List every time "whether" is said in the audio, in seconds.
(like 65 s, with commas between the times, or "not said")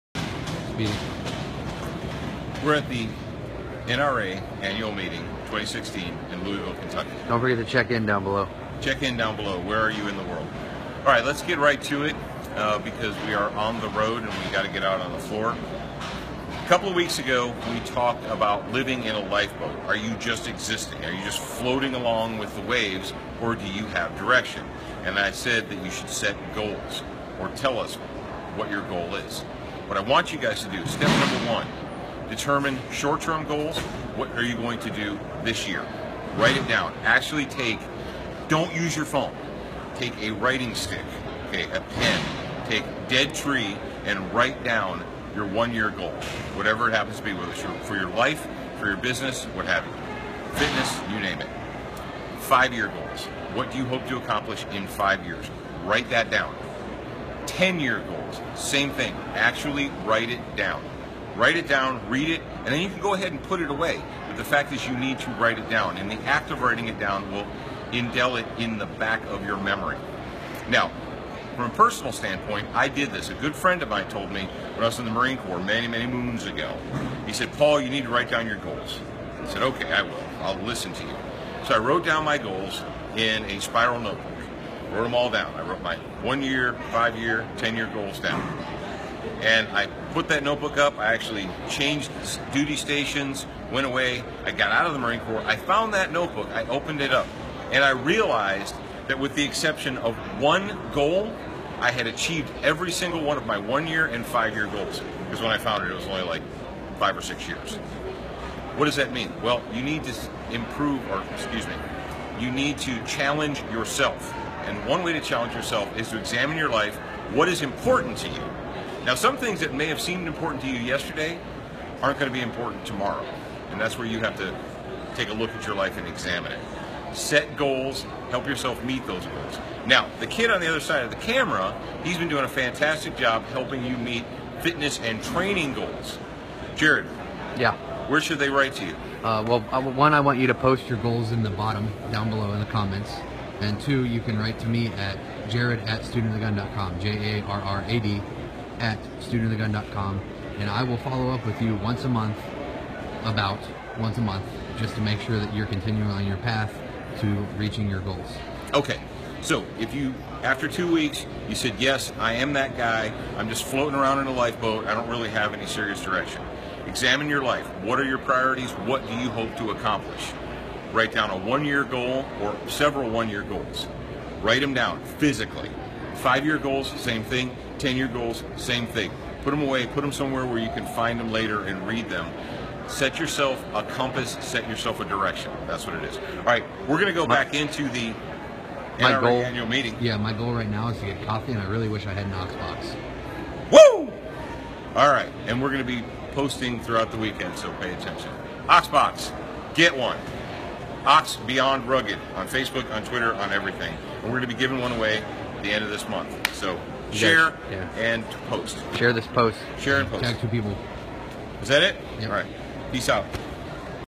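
47 s.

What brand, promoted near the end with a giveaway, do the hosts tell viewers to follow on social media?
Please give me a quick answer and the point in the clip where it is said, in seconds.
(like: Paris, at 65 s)
Ox Beyond Rugged, at 201 s.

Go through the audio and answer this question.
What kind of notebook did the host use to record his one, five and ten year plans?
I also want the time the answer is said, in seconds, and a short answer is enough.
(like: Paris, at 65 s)
spiral notebook, at 83 s.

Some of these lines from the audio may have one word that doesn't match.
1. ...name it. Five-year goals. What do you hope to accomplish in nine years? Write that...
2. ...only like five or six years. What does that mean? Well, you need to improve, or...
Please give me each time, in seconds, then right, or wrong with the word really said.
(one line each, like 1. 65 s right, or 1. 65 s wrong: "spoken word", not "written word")
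1. 51 s wrong: "five", not "nine"
2. 106 s right.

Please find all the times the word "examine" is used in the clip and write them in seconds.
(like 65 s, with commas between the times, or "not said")
116 s, 126 s, 166 s.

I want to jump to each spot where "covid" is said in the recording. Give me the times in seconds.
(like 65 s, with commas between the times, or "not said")
not said.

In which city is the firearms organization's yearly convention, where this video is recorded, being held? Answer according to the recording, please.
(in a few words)
Louisville.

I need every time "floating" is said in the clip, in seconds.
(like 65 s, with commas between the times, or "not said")
21 s, 163 s.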